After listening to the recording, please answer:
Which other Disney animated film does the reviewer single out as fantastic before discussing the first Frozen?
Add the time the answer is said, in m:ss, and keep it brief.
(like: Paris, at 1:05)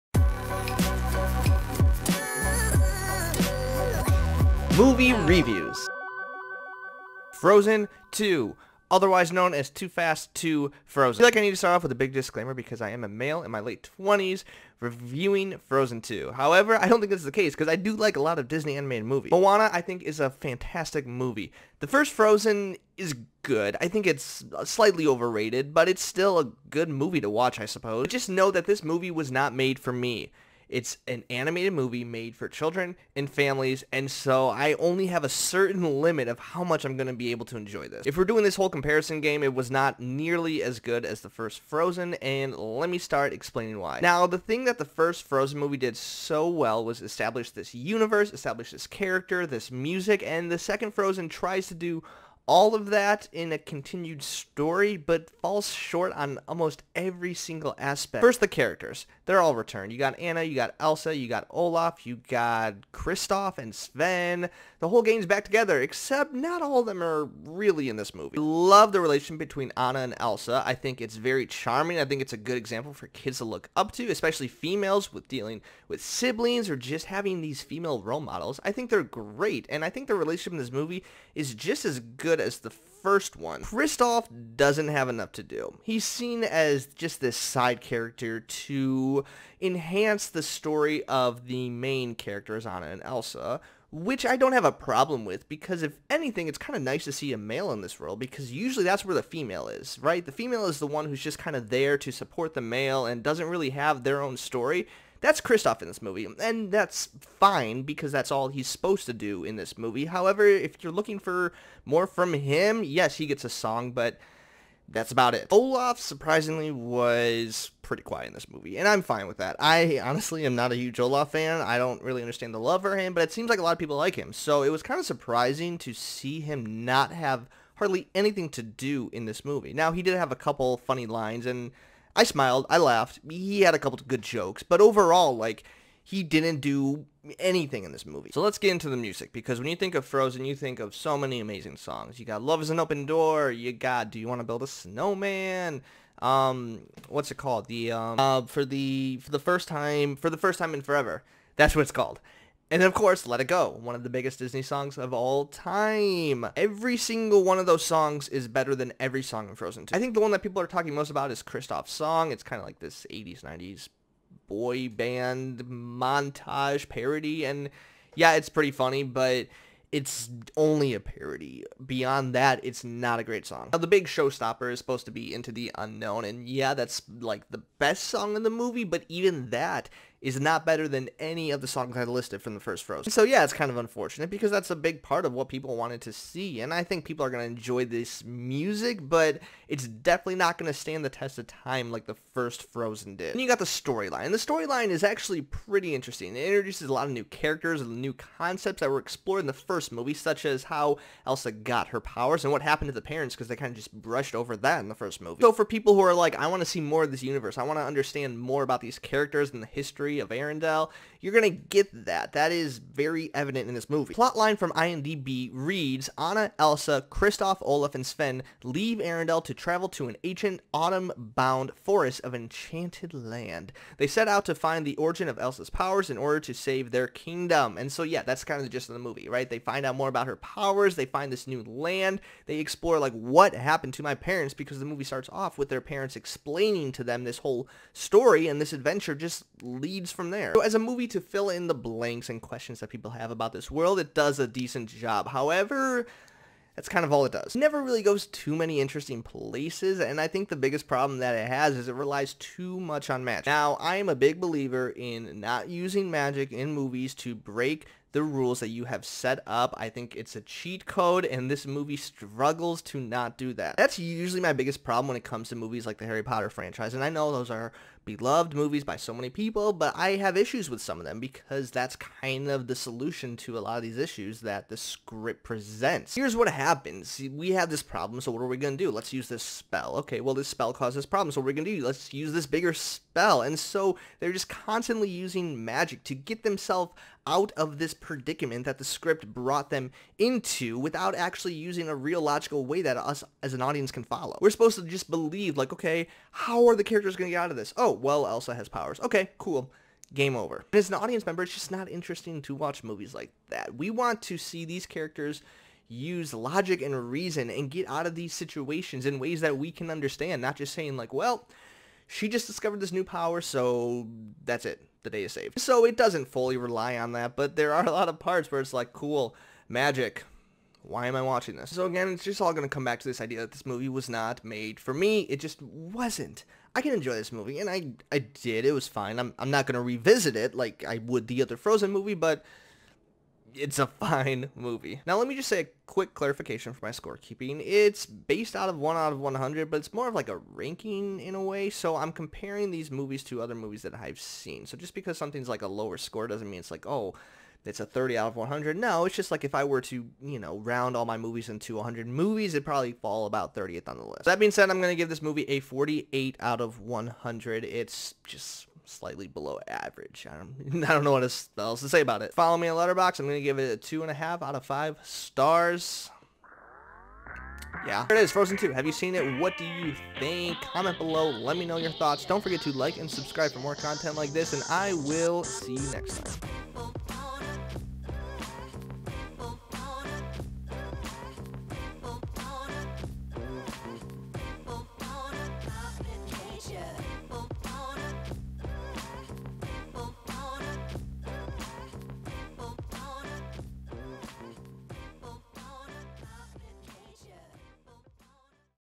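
Moana, at 0:19.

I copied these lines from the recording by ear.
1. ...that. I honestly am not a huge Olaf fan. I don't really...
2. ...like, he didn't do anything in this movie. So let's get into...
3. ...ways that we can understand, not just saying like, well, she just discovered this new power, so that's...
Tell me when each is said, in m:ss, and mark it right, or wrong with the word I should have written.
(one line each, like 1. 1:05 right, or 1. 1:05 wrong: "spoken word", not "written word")
1. 1:59 right
2. 2:15 right
3. 5:09 right.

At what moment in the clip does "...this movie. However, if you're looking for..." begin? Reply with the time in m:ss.
1:49.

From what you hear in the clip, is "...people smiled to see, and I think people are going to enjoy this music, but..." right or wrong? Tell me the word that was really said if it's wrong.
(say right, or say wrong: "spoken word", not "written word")
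wrong: "wanted", not "smiled".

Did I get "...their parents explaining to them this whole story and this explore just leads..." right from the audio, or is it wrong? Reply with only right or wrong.
wrong.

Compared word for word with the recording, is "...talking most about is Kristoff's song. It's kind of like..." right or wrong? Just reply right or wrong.
right.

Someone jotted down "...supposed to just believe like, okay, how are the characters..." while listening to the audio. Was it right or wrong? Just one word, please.
right.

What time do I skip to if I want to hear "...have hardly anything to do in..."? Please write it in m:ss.
2:07.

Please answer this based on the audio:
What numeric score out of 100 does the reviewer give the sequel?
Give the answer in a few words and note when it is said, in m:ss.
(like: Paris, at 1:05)
48, at 5:55.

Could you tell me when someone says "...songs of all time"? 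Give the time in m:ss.
2:34.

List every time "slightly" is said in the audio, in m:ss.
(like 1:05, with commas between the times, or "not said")
0:24, 5:58.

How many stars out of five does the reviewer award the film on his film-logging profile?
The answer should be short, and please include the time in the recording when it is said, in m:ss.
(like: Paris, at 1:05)
2.5, at 6:03.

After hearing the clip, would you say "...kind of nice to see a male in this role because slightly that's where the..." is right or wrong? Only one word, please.
wrong.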